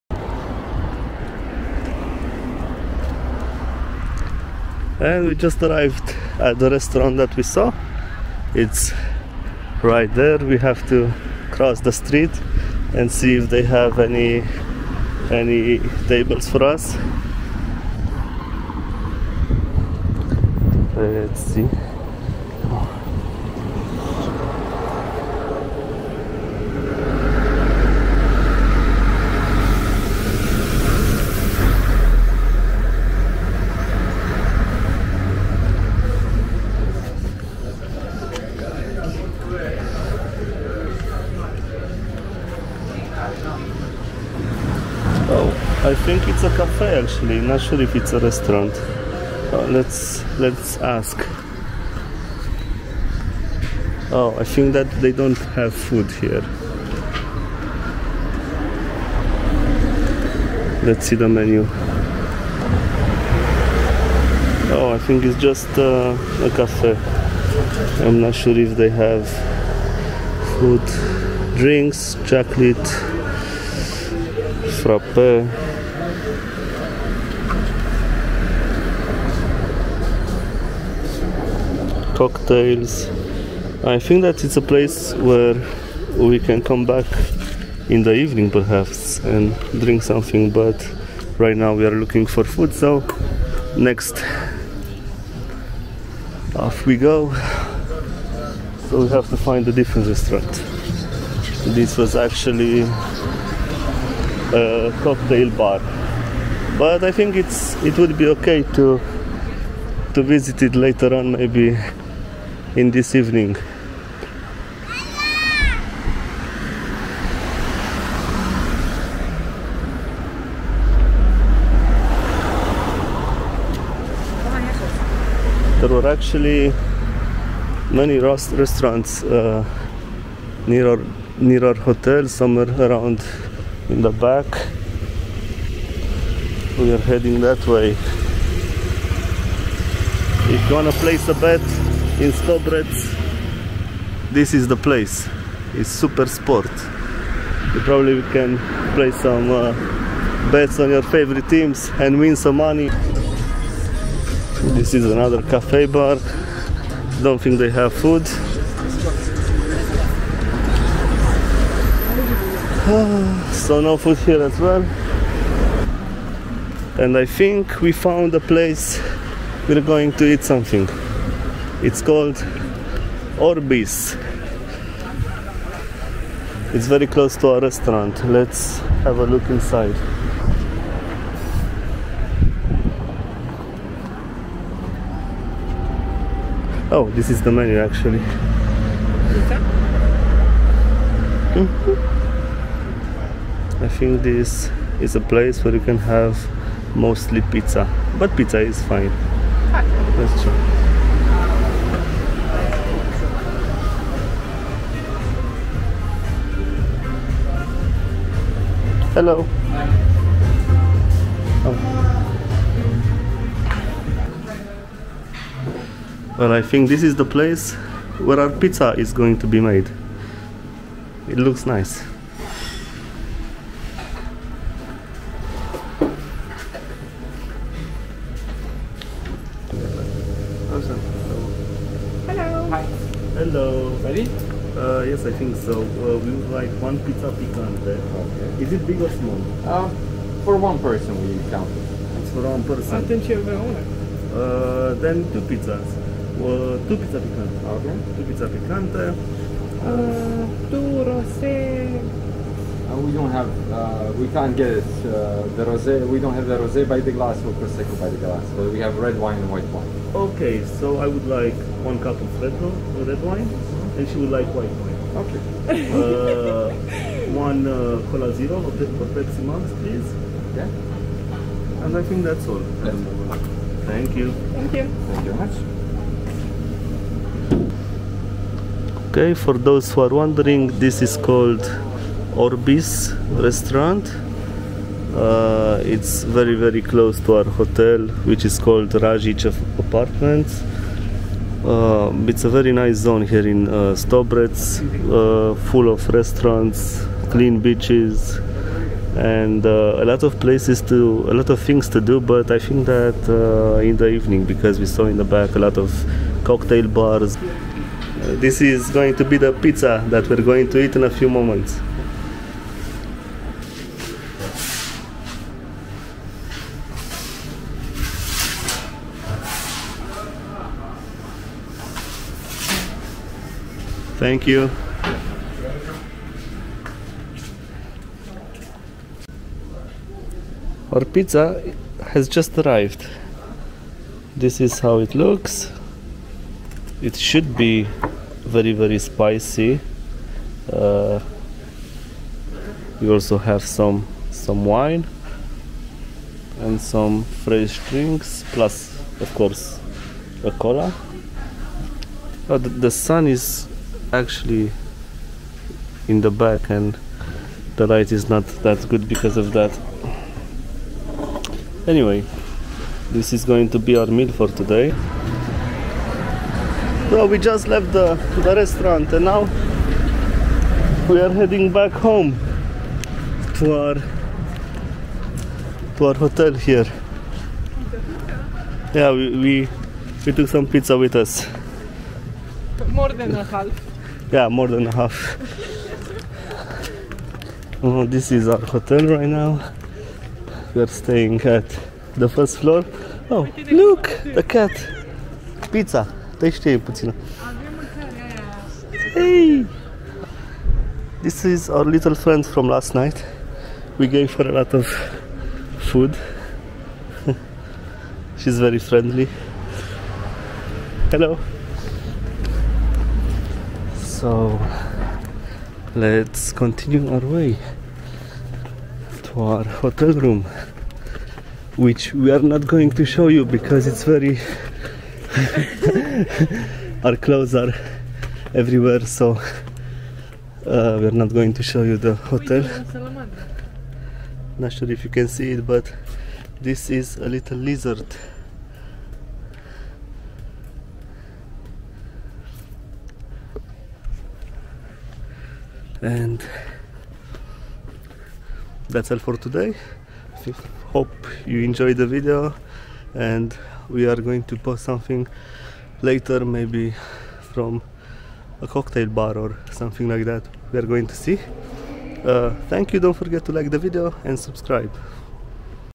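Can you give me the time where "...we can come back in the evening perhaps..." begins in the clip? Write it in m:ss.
1:26.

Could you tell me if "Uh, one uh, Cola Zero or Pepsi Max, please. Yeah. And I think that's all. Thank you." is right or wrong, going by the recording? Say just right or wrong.
right.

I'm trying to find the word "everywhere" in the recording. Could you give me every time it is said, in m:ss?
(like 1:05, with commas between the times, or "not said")
7:08.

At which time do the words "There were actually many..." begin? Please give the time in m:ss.
2:05.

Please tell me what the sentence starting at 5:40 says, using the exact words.
Uh, we also have some some wine and some fresh drinks plus of course a cola.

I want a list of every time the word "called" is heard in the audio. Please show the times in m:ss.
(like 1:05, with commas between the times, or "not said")
2:52, 4:41, 4:48.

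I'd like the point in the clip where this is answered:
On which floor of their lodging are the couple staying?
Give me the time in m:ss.
6:32.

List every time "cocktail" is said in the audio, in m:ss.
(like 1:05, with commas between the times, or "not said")
1:22, 1:45, 5:06, 7:38.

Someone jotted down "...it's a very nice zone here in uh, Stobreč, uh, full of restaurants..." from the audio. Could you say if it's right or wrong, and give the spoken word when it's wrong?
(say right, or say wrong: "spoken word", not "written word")
right.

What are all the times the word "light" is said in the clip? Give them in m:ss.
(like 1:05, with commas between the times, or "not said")
5:57.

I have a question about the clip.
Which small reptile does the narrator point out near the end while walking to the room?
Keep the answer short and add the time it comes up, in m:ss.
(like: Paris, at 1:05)
Lizard, at 7:17.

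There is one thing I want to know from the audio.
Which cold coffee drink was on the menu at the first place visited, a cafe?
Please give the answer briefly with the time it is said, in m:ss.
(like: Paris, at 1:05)
Chocolate frappé, at 1:12.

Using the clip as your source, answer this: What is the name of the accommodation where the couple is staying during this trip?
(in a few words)
Rajic Apartments.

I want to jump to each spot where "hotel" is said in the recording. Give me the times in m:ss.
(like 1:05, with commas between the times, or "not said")
2:11, 4:47, 6:16, 6:28, 6:59, 7:12.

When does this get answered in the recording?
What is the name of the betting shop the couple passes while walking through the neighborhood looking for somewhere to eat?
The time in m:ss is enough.
2:25.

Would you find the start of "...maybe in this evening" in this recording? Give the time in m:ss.
1:51.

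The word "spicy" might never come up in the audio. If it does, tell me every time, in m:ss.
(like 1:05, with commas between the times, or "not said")
5:38.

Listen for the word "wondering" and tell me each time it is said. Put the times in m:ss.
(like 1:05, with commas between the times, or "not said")
4:40.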